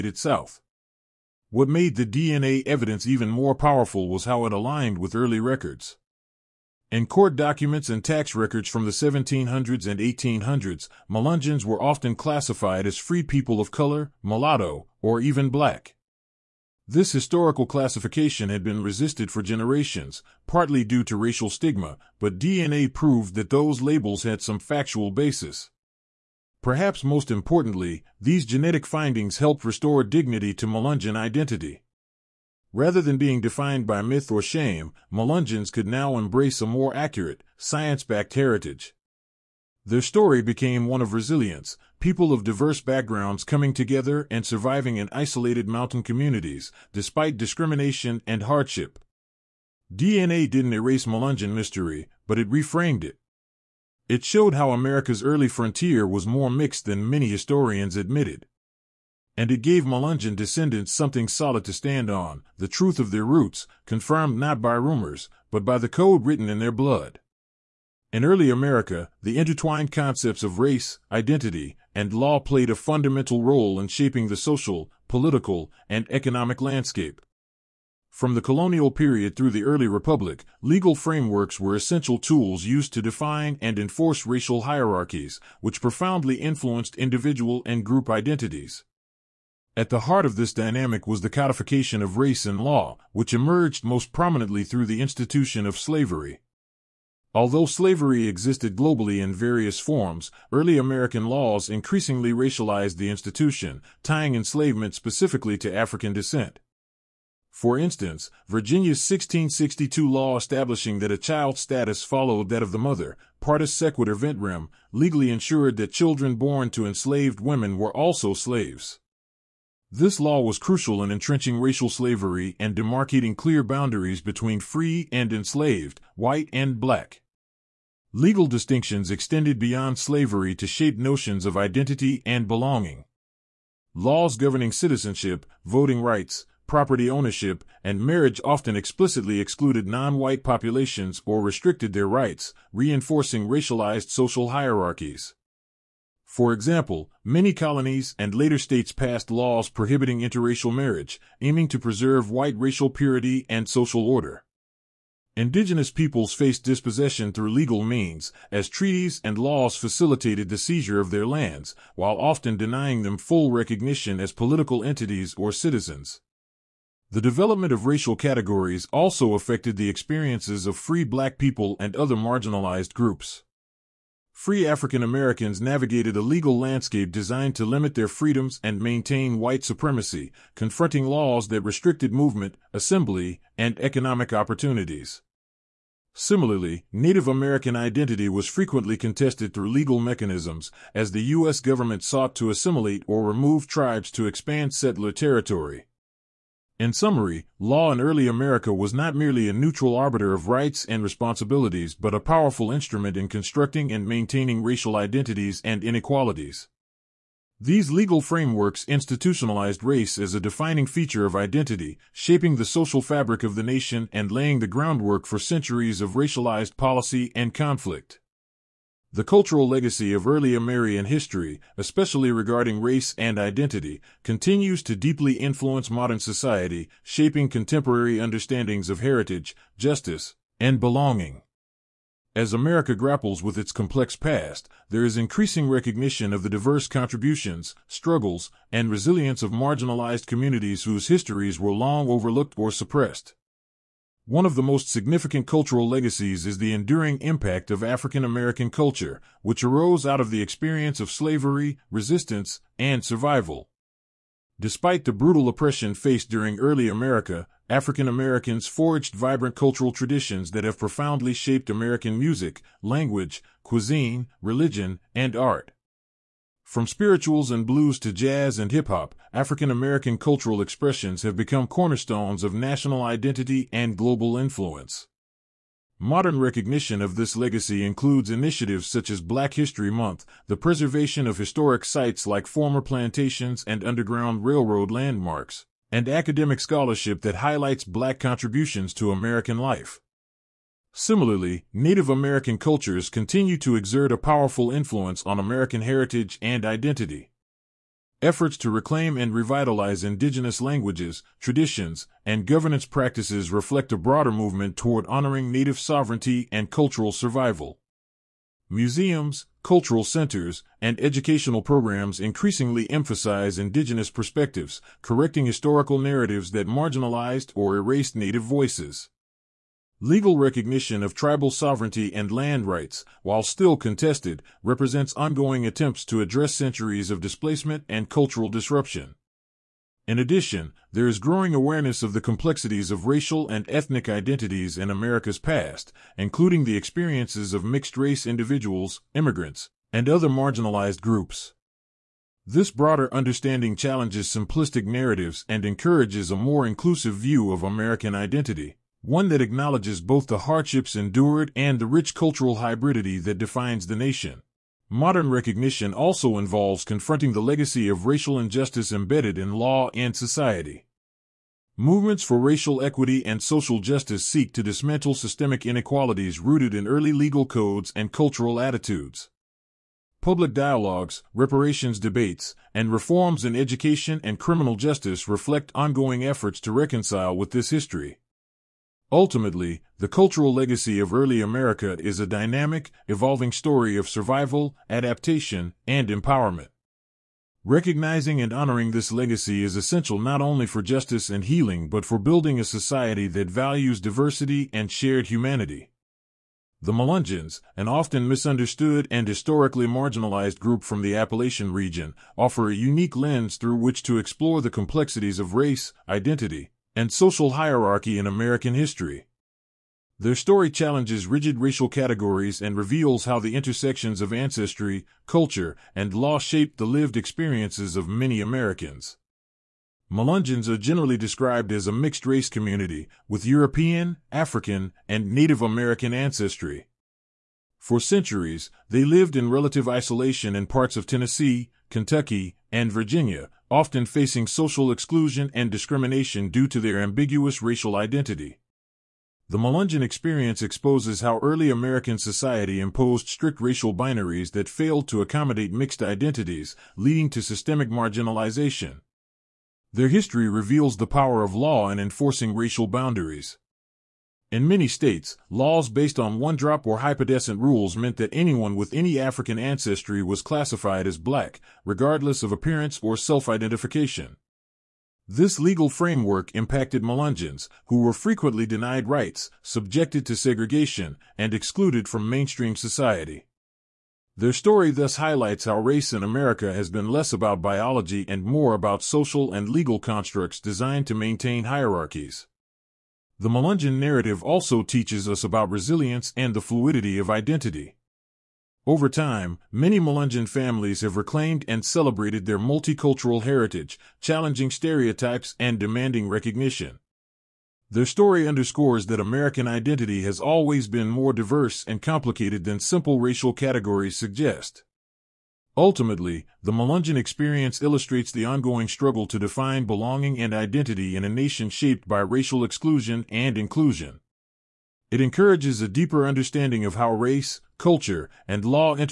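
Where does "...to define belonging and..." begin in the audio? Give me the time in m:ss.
8:29.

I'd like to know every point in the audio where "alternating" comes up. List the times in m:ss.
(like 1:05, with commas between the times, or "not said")
not said.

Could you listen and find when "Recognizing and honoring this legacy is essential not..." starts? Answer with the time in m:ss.
6:27.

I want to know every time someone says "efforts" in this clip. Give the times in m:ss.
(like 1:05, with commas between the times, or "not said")
4:58, 6:16.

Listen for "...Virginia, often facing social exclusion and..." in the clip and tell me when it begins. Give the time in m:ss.
7:12.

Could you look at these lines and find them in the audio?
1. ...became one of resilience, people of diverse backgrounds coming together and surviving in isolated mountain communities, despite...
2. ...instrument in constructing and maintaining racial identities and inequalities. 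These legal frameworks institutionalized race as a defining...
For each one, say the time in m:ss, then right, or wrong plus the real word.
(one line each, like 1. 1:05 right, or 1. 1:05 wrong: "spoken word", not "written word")
1. 0:40 right
2. 3:22 right.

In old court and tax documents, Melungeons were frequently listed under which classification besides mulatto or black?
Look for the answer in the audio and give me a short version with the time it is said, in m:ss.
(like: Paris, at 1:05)
free people of color, at 0:12.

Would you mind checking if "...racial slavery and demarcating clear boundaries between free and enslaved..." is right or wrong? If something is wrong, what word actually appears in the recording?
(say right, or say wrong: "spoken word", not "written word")
right.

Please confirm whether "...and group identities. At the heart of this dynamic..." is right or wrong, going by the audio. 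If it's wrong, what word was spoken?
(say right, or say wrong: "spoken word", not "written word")
right.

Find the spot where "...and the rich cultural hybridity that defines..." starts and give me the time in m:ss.
5:51.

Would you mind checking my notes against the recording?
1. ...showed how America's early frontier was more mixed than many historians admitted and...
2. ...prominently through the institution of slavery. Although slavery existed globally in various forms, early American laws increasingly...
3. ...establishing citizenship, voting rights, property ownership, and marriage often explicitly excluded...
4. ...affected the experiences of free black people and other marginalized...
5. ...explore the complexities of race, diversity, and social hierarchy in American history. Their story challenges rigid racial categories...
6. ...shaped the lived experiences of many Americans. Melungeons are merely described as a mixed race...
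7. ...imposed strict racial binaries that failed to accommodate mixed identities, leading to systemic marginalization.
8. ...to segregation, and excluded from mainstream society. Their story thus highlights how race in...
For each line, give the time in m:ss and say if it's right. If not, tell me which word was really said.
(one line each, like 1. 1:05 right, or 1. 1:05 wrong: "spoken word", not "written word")
1. 0:54 right
2. 1:34 right
3. 2:14 wrong: "governing", not "establishing"
4. 2:49 right
5. 6:44 wrong: "identity", not "diversity"
6. 6:56 wrong: "generally", not "merely"
7. 7:22 right
8. 7:50 right.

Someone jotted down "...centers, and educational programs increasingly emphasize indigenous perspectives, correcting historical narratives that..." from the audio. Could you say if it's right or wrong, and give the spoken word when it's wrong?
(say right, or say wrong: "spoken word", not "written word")
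right.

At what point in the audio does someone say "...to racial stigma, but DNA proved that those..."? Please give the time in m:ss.
0:21.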